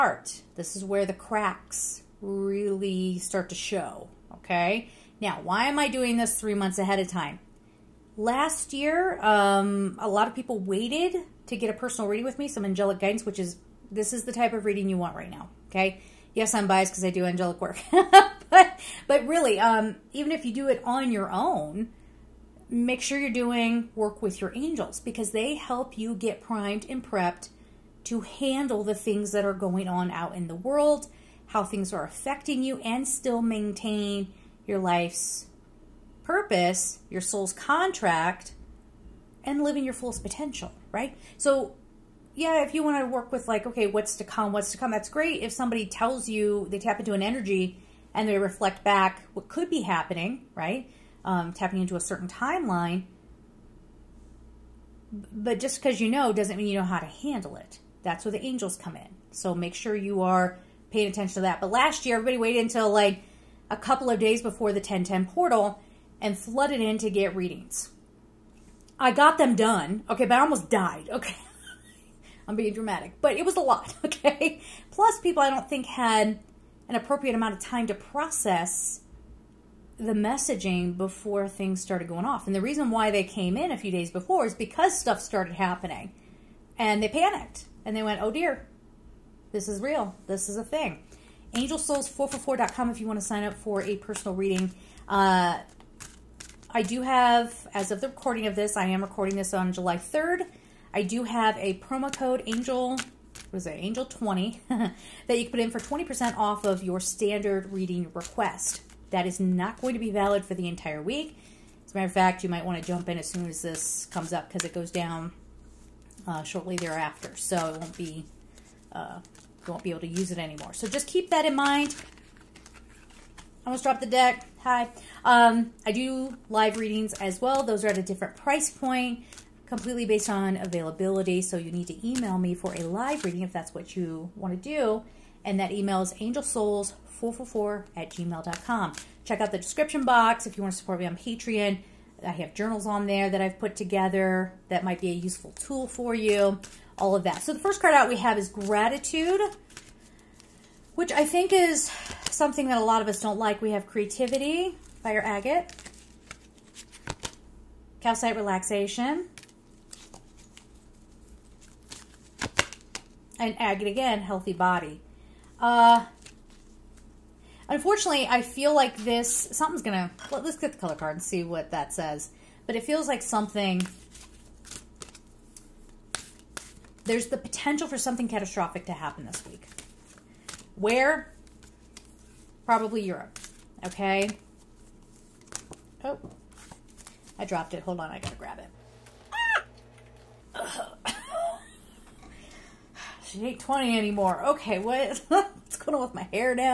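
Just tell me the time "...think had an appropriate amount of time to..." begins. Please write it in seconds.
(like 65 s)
75 s.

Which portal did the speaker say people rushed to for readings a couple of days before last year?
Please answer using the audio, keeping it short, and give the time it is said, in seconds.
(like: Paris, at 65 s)
1010 portal, at 64 s.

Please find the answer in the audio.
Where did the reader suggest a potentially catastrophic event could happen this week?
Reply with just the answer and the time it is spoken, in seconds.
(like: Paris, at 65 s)
Europe, at 183 s.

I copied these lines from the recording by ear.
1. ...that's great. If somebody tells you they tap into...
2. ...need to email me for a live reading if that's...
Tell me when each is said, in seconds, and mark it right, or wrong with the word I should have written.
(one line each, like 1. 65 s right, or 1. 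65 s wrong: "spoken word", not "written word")
1. 44 s right
2. 131 s right.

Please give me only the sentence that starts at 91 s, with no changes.
AngelSouls444.com if you want to sign up for a personal reading.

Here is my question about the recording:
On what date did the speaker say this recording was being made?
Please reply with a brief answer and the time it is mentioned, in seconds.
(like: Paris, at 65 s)
July 3rd, at 99 s.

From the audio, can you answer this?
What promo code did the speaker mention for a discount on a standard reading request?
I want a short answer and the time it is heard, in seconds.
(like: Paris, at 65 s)
ANGEL20, at 103 s.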